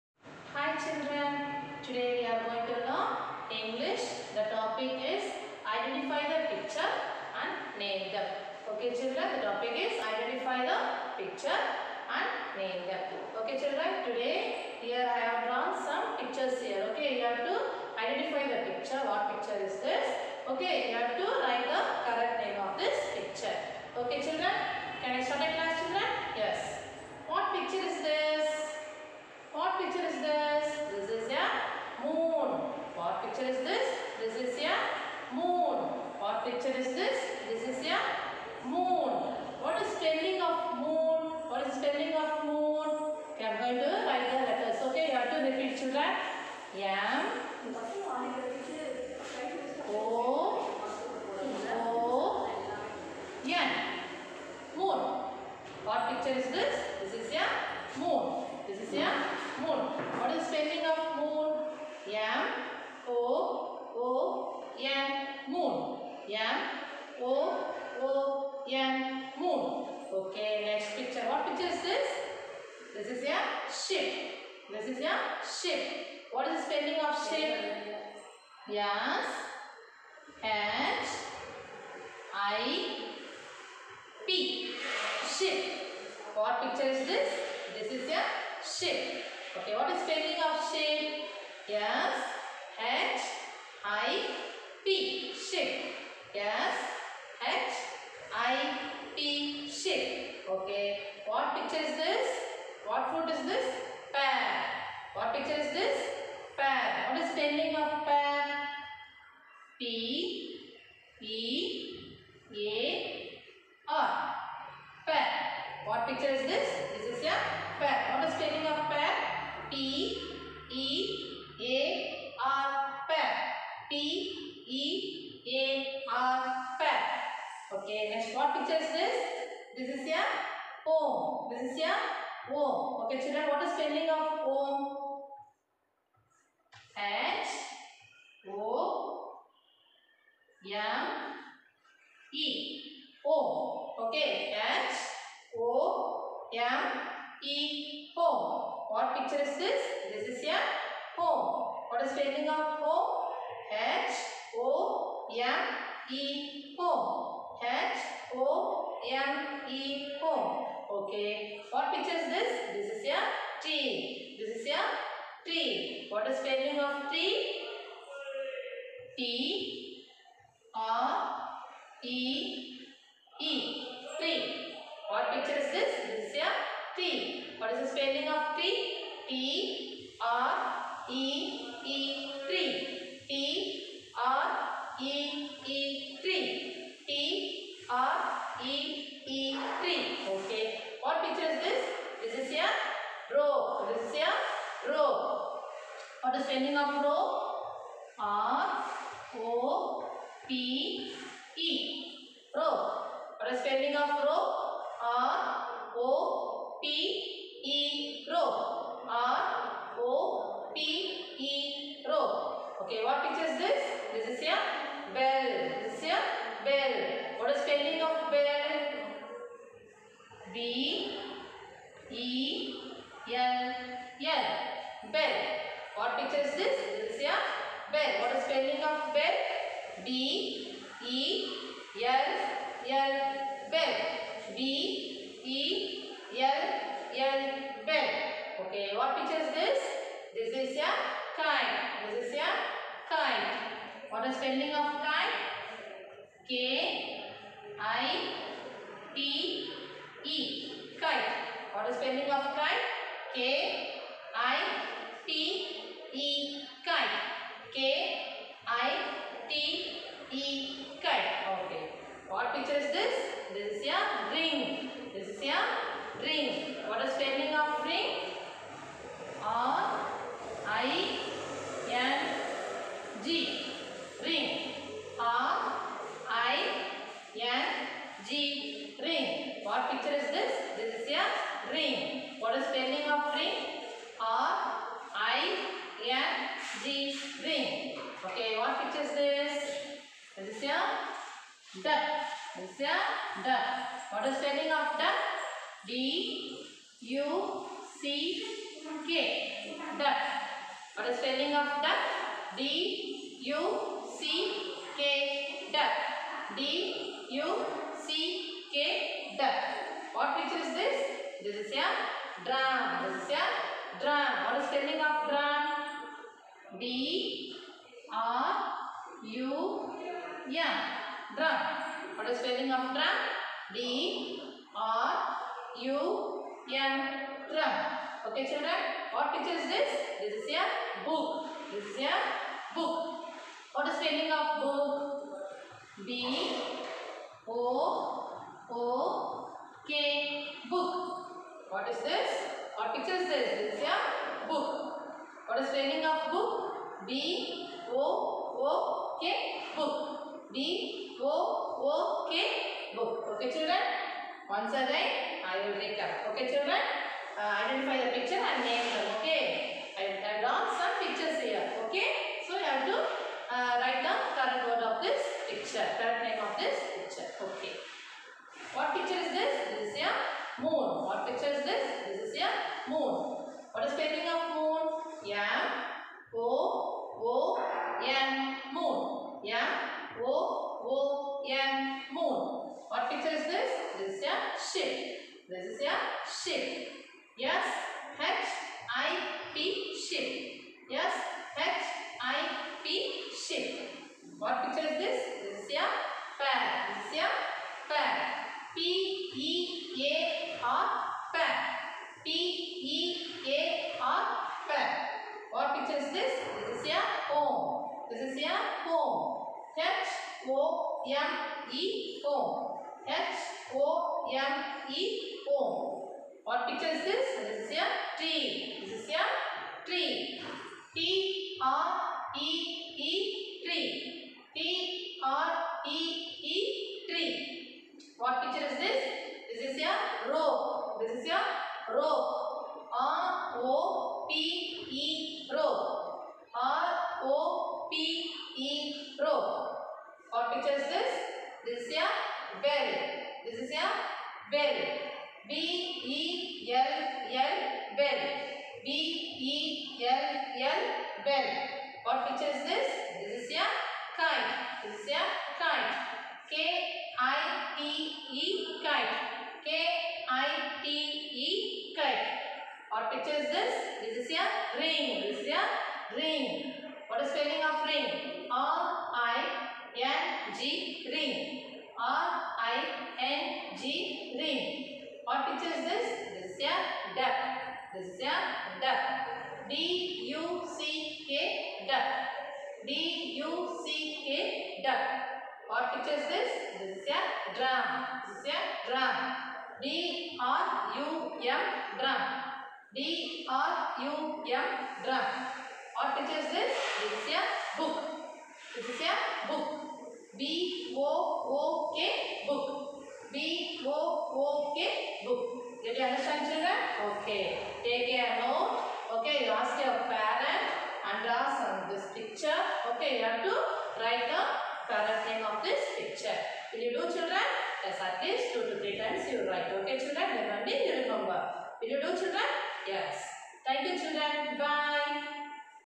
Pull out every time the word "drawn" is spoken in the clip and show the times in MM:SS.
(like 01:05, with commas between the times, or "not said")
00:15, 06:00.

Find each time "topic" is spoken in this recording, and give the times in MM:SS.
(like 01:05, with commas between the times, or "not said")
00:04, 00:09.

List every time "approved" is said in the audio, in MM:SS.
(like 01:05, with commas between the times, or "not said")
not said.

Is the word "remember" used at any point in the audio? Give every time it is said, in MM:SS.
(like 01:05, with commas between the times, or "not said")
08:41.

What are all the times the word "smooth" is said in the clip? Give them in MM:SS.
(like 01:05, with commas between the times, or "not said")
not said.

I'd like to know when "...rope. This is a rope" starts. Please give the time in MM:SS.
07:10.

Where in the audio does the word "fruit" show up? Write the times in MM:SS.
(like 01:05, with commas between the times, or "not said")
01:43.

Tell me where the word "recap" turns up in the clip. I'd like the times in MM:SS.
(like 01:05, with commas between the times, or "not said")
05:55.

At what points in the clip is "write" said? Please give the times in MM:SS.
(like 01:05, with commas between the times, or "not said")
00:21, 00:44, 06:03, 08:33, 08:39.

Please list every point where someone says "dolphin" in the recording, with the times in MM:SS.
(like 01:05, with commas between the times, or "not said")
not said.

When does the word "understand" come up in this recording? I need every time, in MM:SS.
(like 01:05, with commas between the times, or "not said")
08:26.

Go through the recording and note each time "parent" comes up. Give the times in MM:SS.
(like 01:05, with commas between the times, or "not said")
08:30, 08:34.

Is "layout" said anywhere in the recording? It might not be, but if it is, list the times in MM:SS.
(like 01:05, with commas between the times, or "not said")
not said.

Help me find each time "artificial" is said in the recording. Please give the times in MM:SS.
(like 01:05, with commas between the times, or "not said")
not said.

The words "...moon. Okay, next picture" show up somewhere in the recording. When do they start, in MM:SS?
01:09.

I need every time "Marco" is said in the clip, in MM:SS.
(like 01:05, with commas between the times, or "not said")
not said.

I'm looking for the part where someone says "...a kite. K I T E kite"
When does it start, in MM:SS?
07:35.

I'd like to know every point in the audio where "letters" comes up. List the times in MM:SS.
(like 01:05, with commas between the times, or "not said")
00:44.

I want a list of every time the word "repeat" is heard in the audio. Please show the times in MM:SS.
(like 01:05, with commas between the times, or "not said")
00:45.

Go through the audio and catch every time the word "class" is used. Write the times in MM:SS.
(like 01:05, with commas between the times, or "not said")
00:25.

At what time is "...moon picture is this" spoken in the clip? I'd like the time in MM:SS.
00:32.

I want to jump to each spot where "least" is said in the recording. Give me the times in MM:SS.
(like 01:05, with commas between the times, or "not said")
08:38.